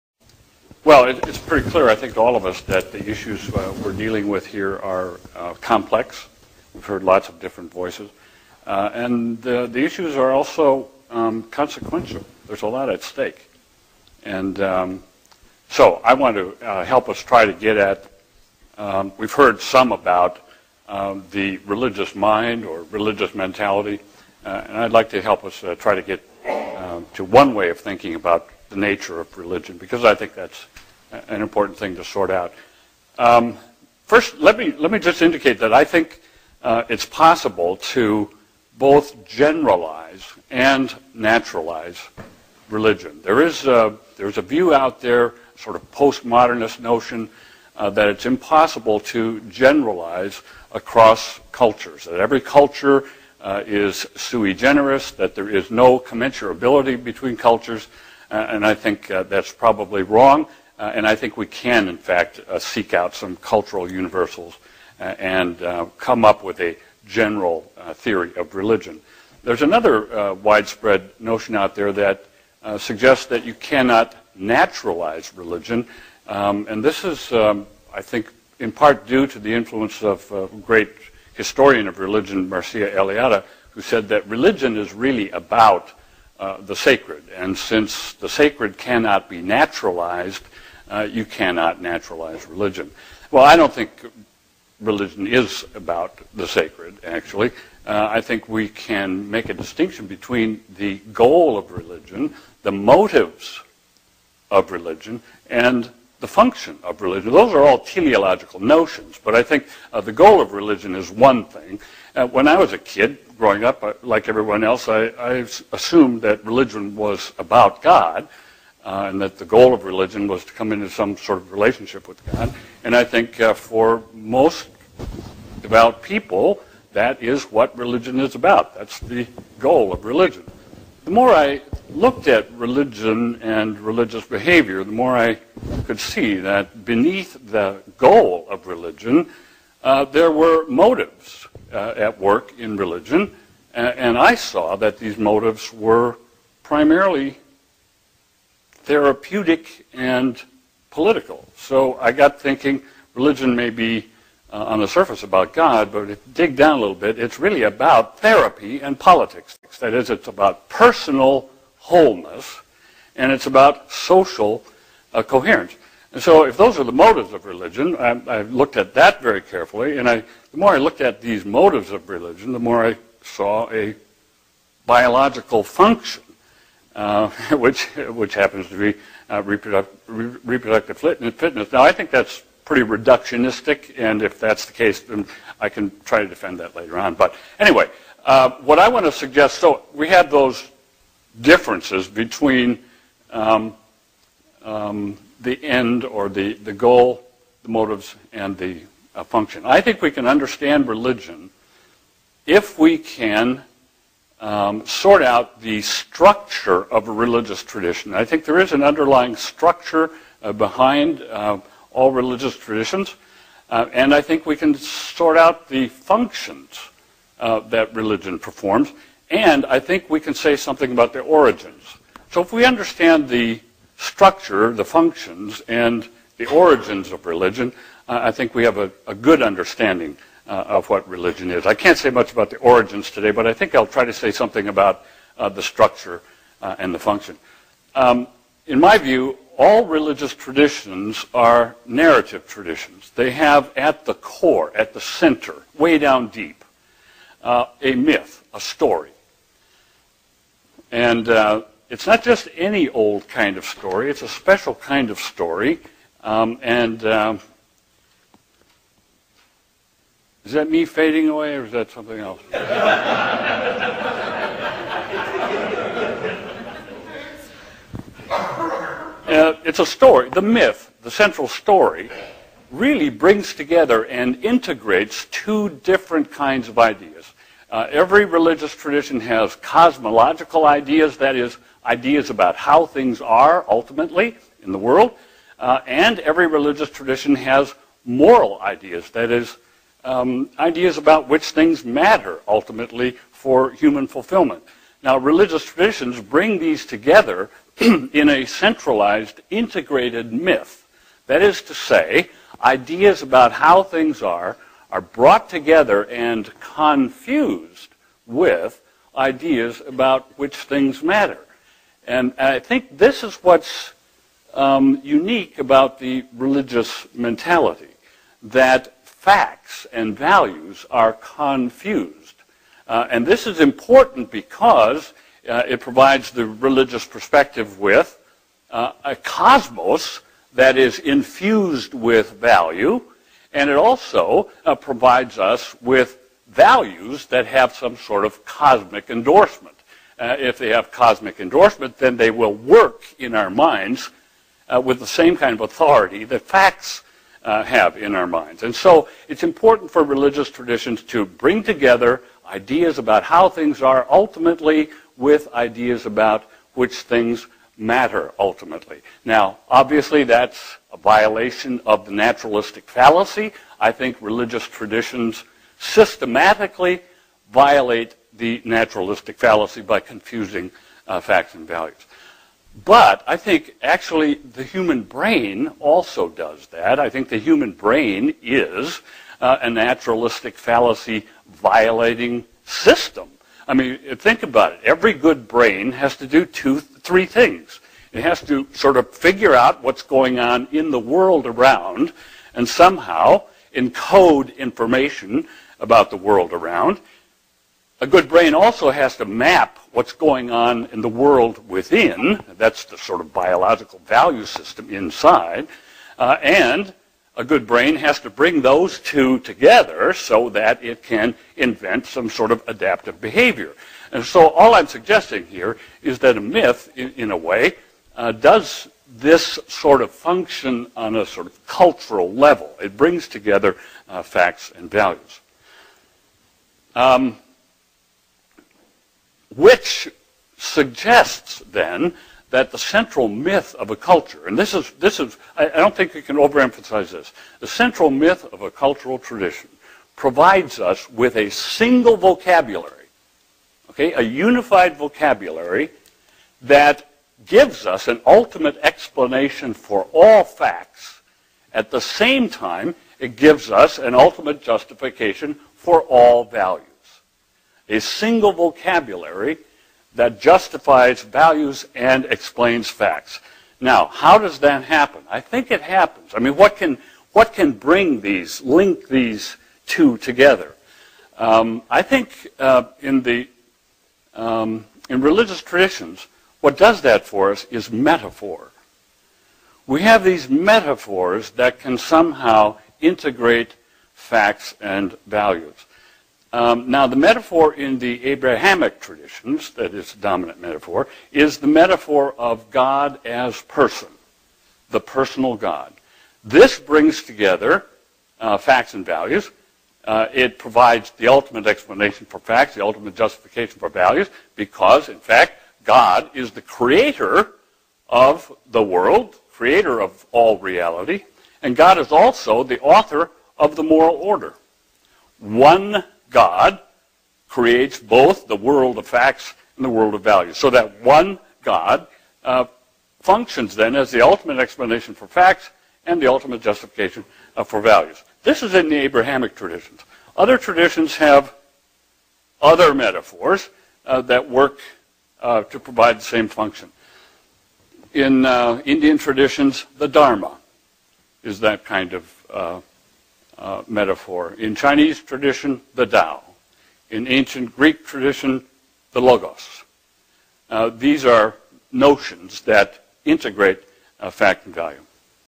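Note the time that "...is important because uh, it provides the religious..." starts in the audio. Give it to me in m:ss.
5:23.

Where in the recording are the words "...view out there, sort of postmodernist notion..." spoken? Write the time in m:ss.
0:44.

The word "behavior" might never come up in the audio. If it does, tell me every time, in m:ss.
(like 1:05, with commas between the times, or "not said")
2:14, 6:53.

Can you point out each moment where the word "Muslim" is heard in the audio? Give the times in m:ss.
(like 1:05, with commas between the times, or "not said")
not said.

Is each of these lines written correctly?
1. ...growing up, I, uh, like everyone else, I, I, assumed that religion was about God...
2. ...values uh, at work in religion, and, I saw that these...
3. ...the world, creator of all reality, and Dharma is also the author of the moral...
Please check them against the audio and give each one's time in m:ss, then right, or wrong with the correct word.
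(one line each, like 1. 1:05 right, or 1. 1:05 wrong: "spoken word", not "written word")
1. 1:53 right
2. 2:20 wrong: "motives", not "values"
3. 8:28 wrong: "God", not "Dharma".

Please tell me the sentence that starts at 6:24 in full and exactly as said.
Every good brain has to do two three things.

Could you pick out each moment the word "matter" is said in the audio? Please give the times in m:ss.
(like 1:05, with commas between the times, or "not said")
4:51, 5:11, 5:57.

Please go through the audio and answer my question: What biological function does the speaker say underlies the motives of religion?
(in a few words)
reproductive fitness.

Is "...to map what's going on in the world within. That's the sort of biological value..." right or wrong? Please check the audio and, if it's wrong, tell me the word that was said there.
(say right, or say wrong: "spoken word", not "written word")
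right.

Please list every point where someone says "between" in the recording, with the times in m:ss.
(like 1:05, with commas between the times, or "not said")
0:57, 1:40, 3:12.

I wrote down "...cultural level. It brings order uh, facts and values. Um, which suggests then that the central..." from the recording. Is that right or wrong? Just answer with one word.
wrong.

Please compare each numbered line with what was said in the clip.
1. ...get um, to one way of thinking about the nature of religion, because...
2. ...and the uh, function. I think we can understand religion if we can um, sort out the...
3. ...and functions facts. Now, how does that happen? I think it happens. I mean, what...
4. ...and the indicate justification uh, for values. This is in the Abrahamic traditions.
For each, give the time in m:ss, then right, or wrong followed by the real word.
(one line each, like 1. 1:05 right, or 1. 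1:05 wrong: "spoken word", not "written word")
1. 0:26 right
2. 3:18 right
3. 7:41 wrong: "explains", not "functions"
4. 8:46 wrong: "ultimate", not "indicate".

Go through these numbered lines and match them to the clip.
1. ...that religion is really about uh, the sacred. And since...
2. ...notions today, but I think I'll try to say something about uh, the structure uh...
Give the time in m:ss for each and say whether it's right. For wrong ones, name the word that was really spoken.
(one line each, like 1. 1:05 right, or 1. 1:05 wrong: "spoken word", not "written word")
1. 1:24 right
2. 3:52 wrong: "origins", not "notions".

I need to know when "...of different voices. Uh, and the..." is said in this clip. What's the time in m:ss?
0:07.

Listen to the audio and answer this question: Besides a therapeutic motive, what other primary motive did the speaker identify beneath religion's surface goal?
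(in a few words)
political.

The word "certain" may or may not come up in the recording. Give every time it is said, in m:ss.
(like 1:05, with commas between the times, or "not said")
not said.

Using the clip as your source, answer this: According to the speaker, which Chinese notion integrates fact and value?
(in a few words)
the Tao.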